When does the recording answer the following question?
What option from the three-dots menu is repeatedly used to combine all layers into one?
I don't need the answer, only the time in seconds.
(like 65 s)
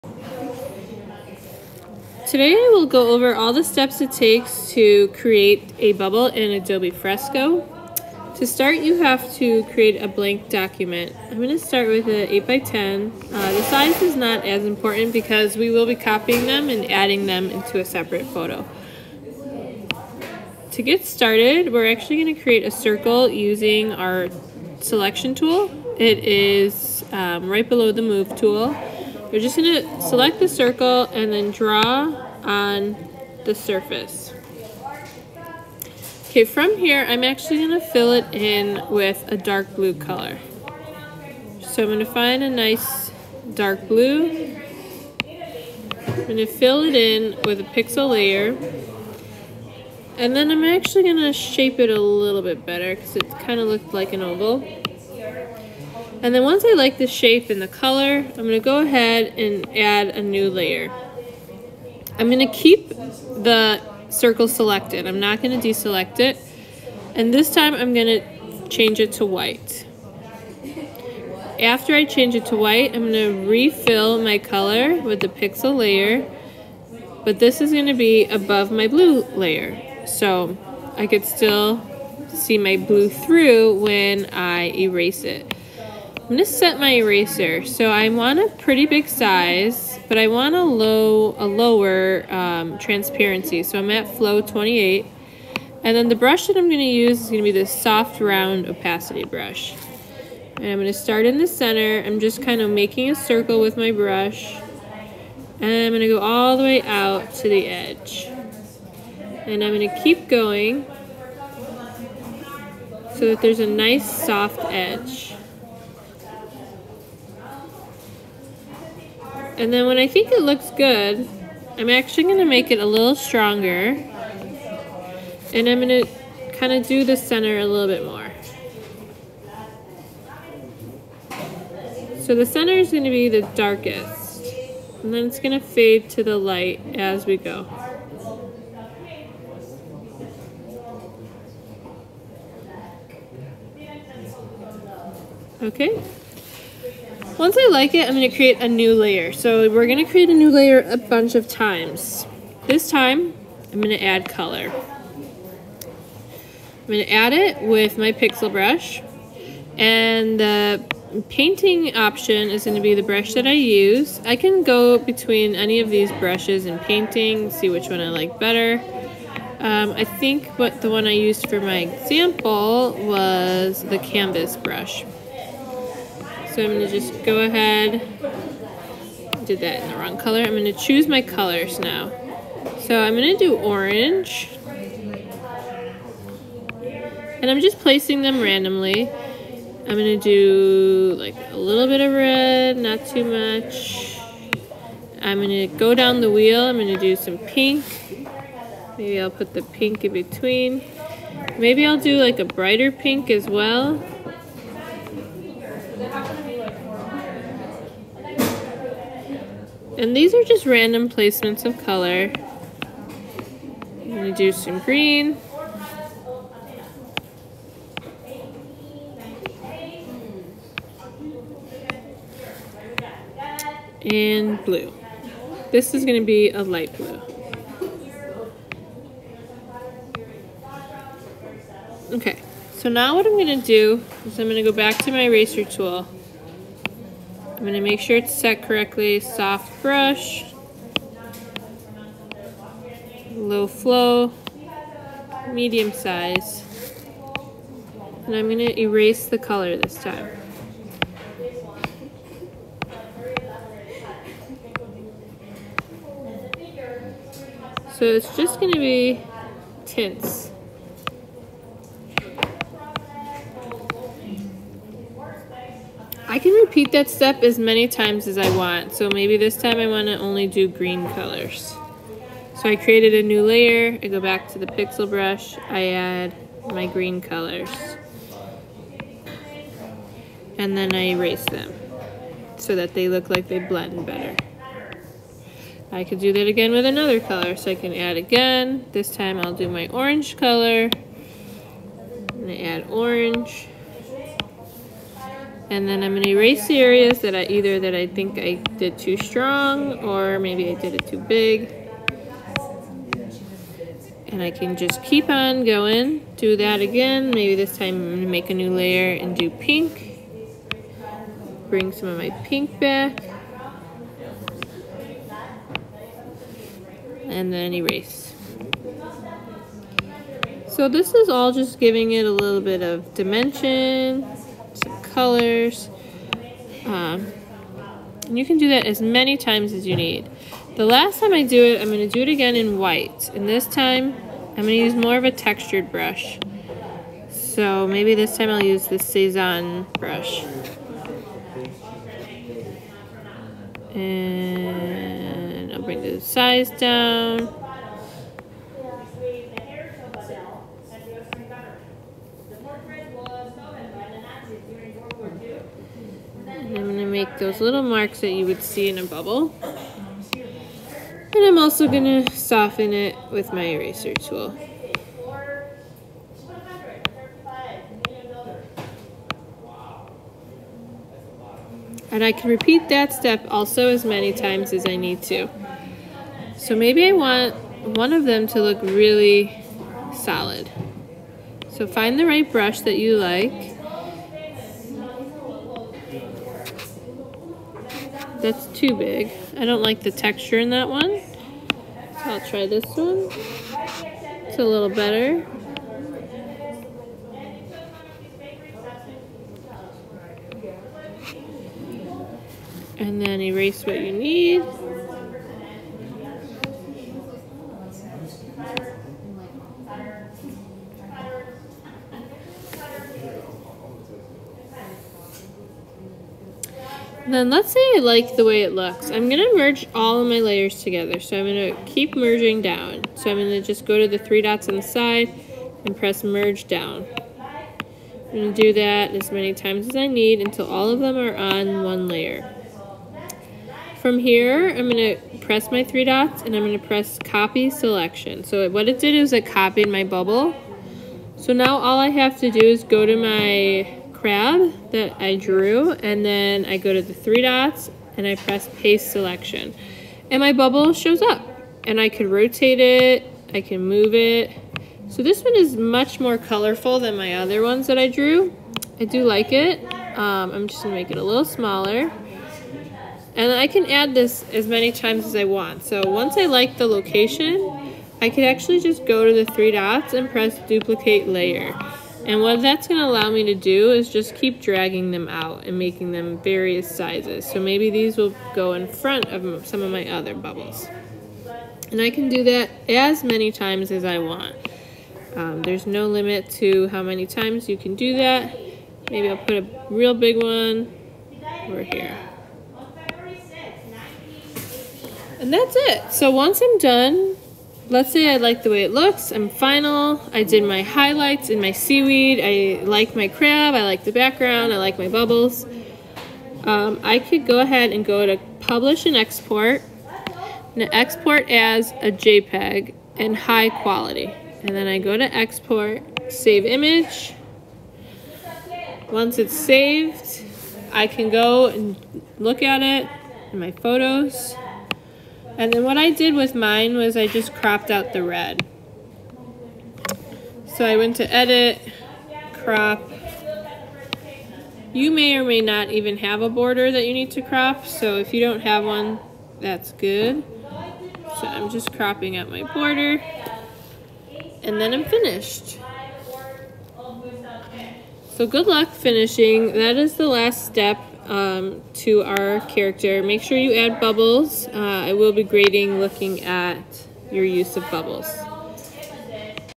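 426 s.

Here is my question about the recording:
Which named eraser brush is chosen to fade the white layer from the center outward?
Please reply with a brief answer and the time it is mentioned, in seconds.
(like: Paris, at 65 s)
soft round opacity brush, at 97 s.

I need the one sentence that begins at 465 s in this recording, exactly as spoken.
So once I like the location, I could actually just go to the three dots and press duplicate layer.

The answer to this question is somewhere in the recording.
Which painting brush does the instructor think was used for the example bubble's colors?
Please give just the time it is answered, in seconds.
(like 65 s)
173 s.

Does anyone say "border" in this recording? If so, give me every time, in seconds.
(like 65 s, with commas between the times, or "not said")
536 s, 542 s.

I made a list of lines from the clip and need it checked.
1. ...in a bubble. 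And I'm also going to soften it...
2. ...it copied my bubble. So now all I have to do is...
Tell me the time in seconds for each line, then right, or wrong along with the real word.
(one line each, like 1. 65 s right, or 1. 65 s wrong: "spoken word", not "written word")
1. 358 s right
2. 439 s right.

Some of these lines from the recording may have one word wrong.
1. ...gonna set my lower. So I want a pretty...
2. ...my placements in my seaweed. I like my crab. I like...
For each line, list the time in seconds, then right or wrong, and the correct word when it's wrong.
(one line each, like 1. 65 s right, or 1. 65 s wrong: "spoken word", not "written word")
1. 86 s wrong: "eraser", not "lower"
2. 500 s wrong: "highlights", not "placements".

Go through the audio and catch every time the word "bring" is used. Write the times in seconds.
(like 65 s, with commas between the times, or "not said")
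311 s, 345 s.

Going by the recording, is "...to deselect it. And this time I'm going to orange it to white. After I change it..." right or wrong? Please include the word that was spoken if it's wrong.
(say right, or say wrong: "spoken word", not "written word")
wrong: "change", not "orange".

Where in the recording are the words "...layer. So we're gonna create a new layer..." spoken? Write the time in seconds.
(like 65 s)
148 s.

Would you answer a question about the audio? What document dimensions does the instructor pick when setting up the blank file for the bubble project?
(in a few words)
8x10.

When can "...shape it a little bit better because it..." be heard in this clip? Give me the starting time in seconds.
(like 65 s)
51 s.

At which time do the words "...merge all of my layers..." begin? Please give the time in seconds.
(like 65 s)
419 s.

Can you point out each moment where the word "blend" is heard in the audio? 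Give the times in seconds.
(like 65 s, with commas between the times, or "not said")
283 s.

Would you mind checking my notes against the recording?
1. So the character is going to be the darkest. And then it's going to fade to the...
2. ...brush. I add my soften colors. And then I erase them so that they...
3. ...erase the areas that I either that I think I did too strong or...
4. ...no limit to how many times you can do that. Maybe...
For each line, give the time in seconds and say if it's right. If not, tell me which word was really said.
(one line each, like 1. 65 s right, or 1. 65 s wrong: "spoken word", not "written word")
1. 132 s wrong: "center", not "character"
2. 275 s wrong: "green", not "soften"
3. 296 s right
4. 485 s right.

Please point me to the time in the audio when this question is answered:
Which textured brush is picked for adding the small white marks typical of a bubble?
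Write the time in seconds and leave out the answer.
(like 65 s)
338 s.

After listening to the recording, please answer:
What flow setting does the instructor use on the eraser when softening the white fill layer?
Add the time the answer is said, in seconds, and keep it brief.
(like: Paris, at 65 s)
28, at 94 s.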